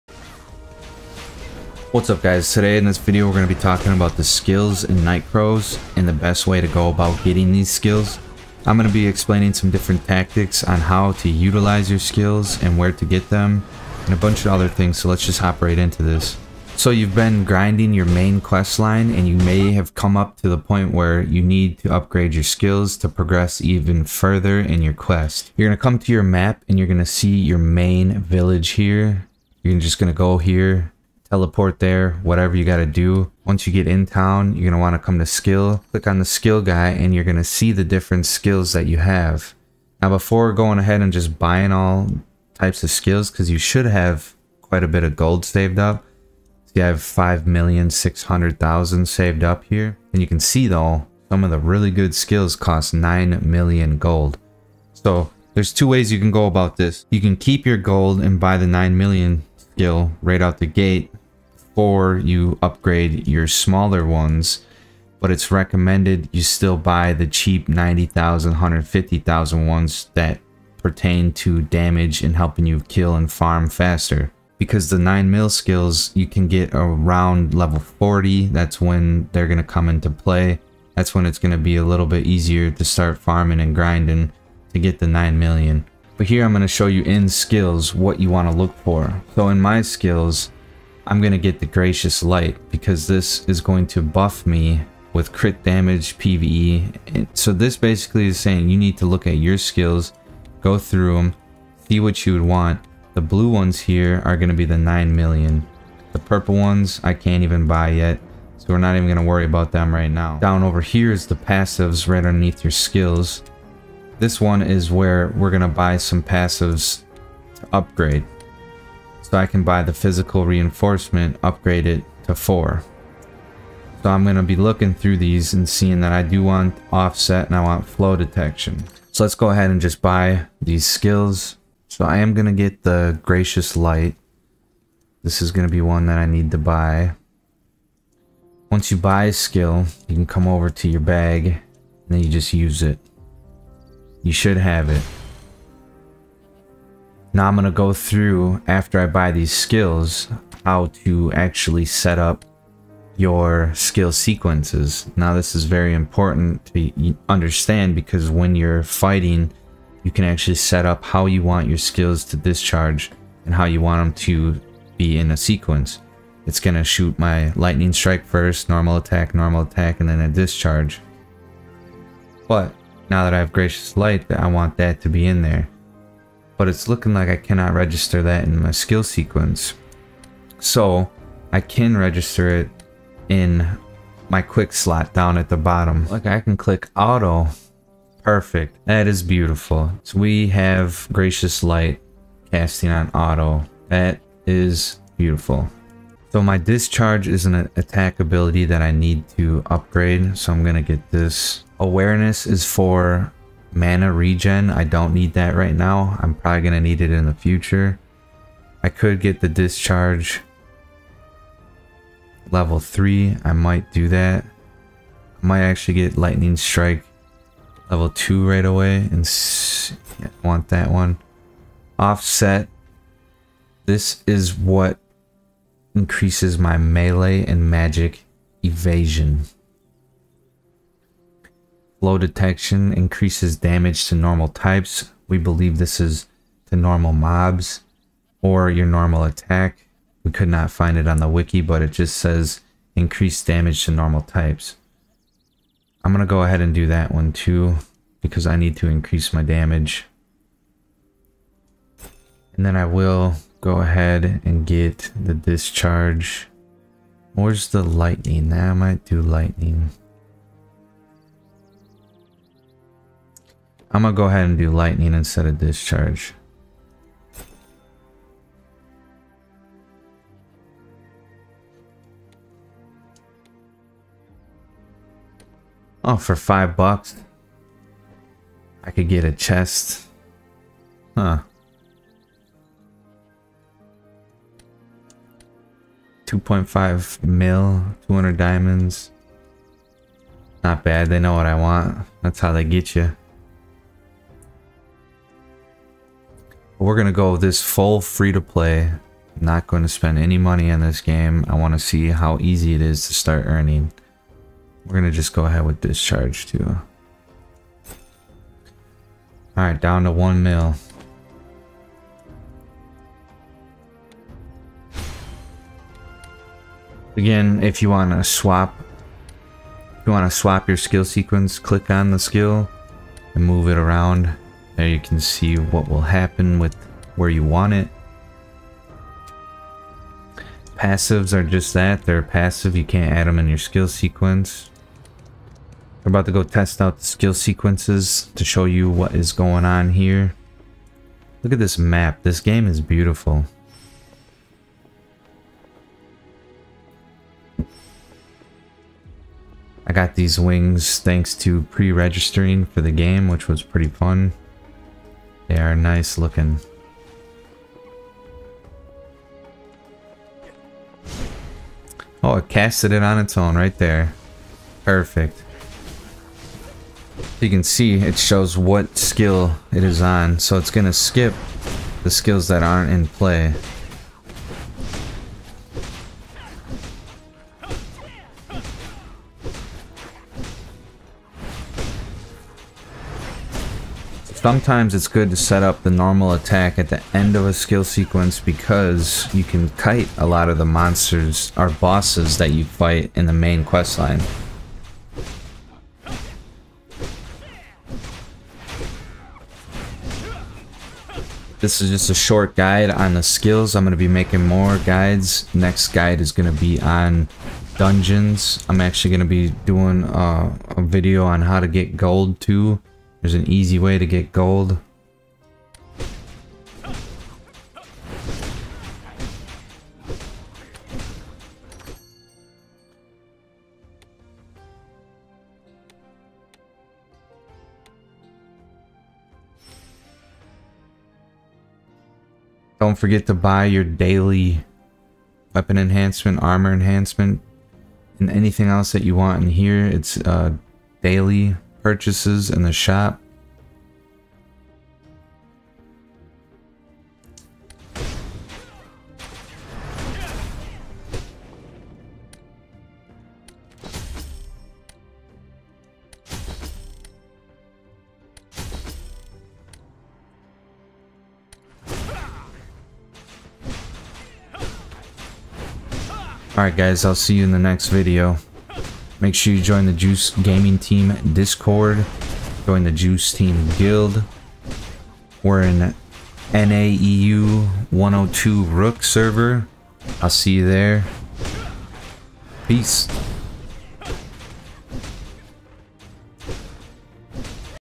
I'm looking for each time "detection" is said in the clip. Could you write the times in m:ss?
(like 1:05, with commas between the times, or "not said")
2:08, 3:52.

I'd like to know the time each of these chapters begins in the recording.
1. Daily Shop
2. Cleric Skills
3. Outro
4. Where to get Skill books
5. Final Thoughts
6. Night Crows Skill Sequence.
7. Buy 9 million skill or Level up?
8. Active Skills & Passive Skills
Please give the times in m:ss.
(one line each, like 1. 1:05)
1. 7:02
2. 3:15
3. 7:45
4. 0:17
5. 5:35
6. 2:30
7. 0:55
8. 1:27.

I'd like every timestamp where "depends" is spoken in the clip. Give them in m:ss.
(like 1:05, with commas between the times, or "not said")
not said.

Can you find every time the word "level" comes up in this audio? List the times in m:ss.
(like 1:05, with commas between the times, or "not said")
1:17, 3:32, 3:37.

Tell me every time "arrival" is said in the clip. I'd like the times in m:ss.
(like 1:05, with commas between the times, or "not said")
not said.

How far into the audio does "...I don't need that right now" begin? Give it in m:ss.
3:24.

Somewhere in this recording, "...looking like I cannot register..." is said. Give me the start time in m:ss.
2:56.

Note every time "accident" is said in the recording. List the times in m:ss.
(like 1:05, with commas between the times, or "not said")
not said.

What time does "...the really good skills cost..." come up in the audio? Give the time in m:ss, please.
0:51.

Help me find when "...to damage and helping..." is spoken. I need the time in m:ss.
1:11.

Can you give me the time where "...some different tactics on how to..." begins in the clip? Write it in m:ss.
0:09.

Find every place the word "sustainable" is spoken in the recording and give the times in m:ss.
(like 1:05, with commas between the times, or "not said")
not said.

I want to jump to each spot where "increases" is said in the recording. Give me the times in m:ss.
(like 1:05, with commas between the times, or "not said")
3:45, 3:52, 4:02, 4:08.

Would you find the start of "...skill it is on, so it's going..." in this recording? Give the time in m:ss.
6:08.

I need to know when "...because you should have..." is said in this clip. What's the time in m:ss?
0:43.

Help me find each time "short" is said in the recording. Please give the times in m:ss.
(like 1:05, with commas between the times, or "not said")
6:42.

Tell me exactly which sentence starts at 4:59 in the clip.
Not going to spend any money in this game.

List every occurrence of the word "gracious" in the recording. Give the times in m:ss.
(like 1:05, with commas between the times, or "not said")
1:31, 2:13, 2:53, 3:11.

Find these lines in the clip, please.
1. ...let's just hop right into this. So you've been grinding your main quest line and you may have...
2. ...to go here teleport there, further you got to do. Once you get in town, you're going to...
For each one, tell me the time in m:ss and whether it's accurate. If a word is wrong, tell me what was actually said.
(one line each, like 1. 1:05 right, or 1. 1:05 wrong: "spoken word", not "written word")
1. 0:15 right
2. 0:30 wrong: "whatever", not "further".